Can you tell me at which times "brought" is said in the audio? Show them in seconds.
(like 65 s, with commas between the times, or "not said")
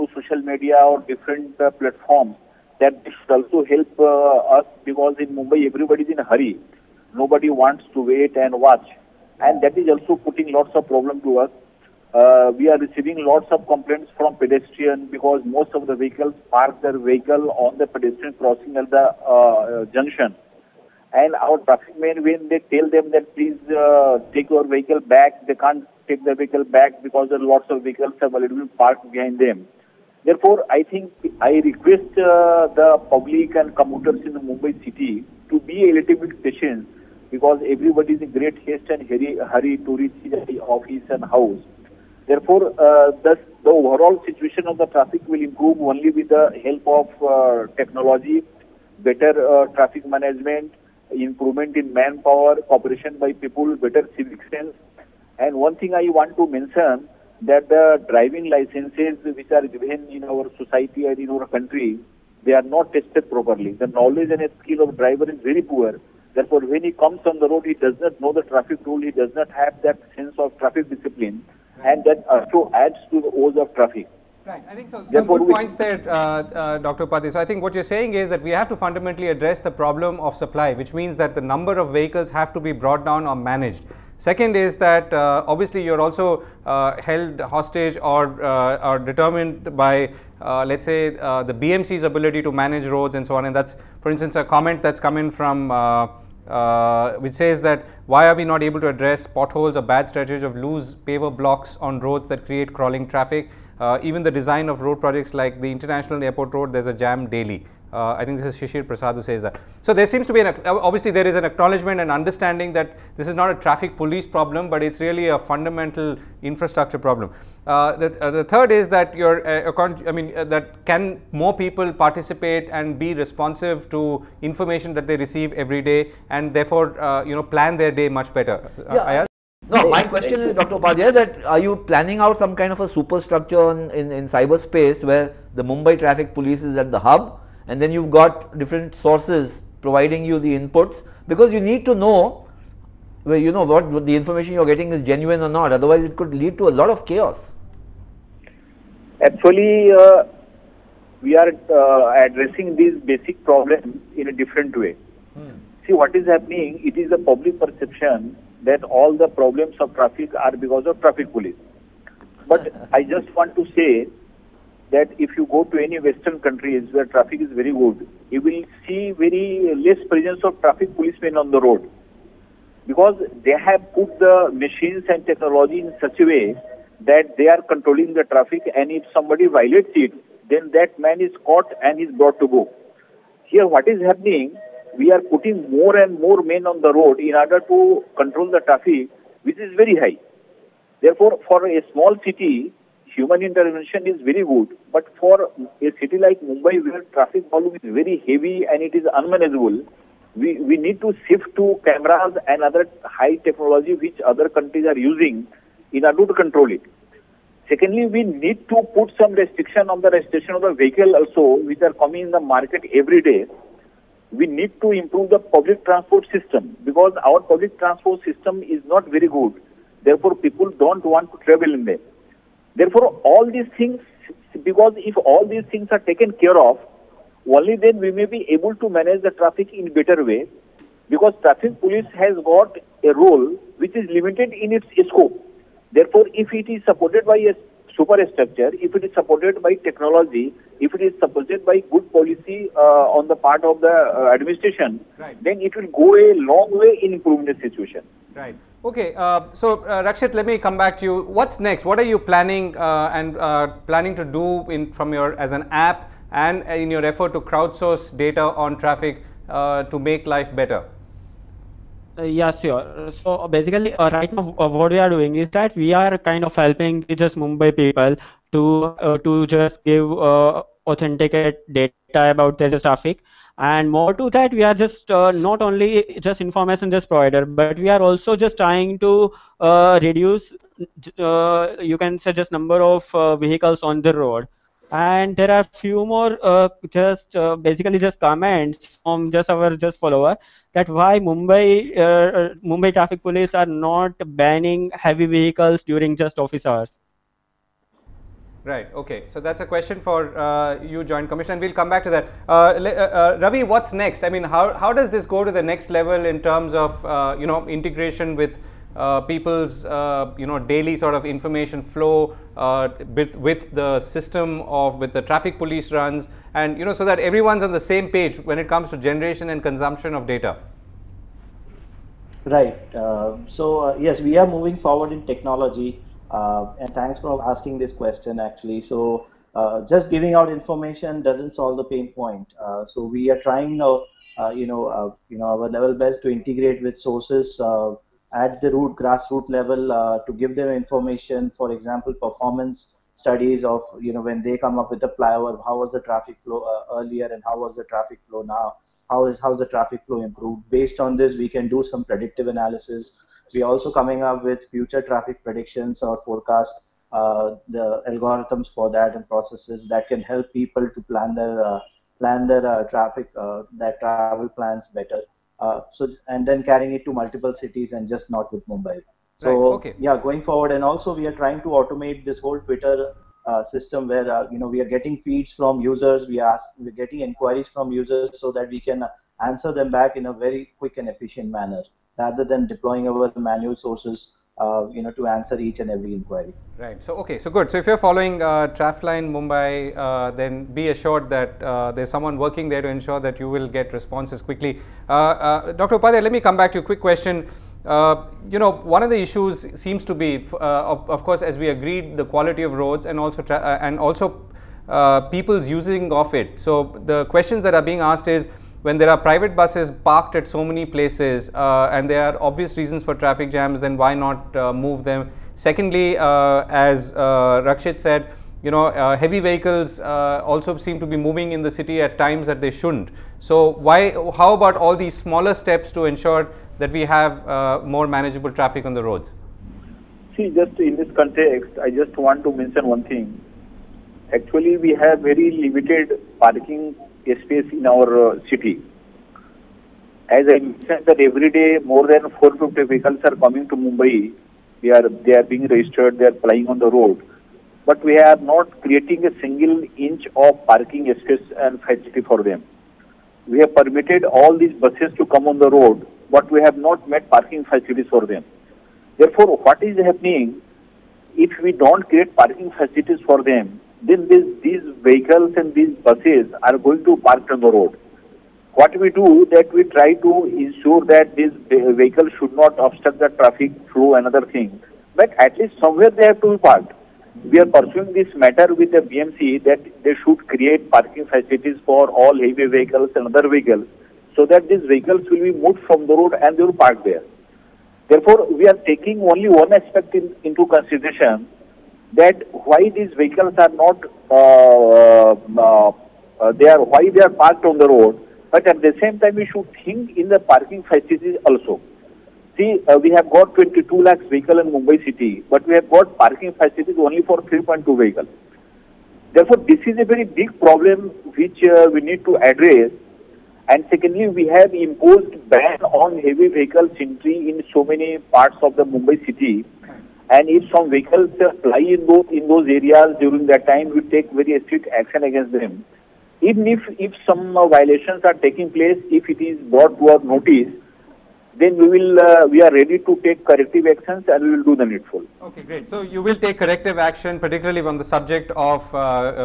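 82 s, 182 s, 529 s.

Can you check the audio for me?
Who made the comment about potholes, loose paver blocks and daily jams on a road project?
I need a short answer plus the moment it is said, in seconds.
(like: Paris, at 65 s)
Shishir Prasad, at 108 s.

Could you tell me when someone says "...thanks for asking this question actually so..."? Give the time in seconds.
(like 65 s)
326 s.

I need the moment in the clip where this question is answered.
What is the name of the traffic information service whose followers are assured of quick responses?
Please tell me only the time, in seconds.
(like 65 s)
388 s.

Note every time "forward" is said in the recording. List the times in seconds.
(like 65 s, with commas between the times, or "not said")
324 s, 370 s.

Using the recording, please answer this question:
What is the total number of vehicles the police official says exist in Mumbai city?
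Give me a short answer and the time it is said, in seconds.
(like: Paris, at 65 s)
22 lakh, at 503 s.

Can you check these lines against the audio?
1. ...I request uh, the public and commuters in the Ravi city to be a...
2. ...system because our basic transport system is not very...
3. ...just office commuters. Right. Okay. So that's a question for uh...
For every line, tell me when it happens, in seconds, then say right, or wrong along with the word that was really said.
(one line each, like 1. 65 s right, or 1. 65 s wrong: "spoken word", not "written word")
1. 31 s wrong: "Mumbai", not "Ravi"
2. 216 s wrong: "public", not "basic"
3. 296 s wrong: "hours", not "commuters".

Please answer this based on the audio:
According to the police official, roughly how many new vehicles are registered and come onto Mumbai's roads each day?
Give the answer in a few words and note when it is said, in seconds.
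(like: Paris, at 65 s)
450, at 442 s.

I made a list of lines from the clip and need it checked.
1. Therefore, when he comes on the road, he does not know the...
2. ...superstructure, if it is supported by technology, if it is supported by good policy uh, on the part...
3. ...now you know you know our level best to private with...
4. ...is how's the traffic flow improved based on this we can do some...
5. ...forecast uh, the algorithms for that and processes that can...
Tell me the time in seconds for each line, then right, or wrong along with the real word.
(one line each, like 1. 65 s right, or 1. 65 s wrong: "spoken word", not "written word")
1. 66 s right
2. 237 s right
3. 333 s wrong: "integrate", not "private"
4. 349 s right
5. 356 s right.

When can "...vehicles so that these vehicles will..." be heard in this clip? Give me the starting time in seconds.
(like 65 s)
483 s.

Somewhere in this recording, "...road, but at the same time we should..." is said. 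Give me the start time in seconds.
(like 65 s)
497 s.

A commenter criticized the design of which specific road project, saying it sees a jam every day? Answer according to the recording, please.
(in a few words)
International Airport Road.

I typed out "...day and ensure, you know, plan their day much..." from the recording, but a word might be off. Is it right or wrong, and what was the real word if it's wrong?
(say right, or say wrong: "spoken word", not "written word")
wrong: "therefore", not "ensure".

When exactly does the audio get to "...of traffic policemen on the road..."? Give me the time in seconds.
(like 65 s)
170 s.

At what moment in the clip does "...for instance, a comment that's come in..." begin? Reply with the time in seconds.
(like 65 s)
94 s.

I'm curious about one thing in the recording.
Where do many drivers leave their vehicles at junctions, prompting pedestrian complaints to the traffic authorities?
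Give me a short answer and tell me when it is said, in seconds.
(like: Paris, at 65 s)
On the pedestrian crossing, at 17 s.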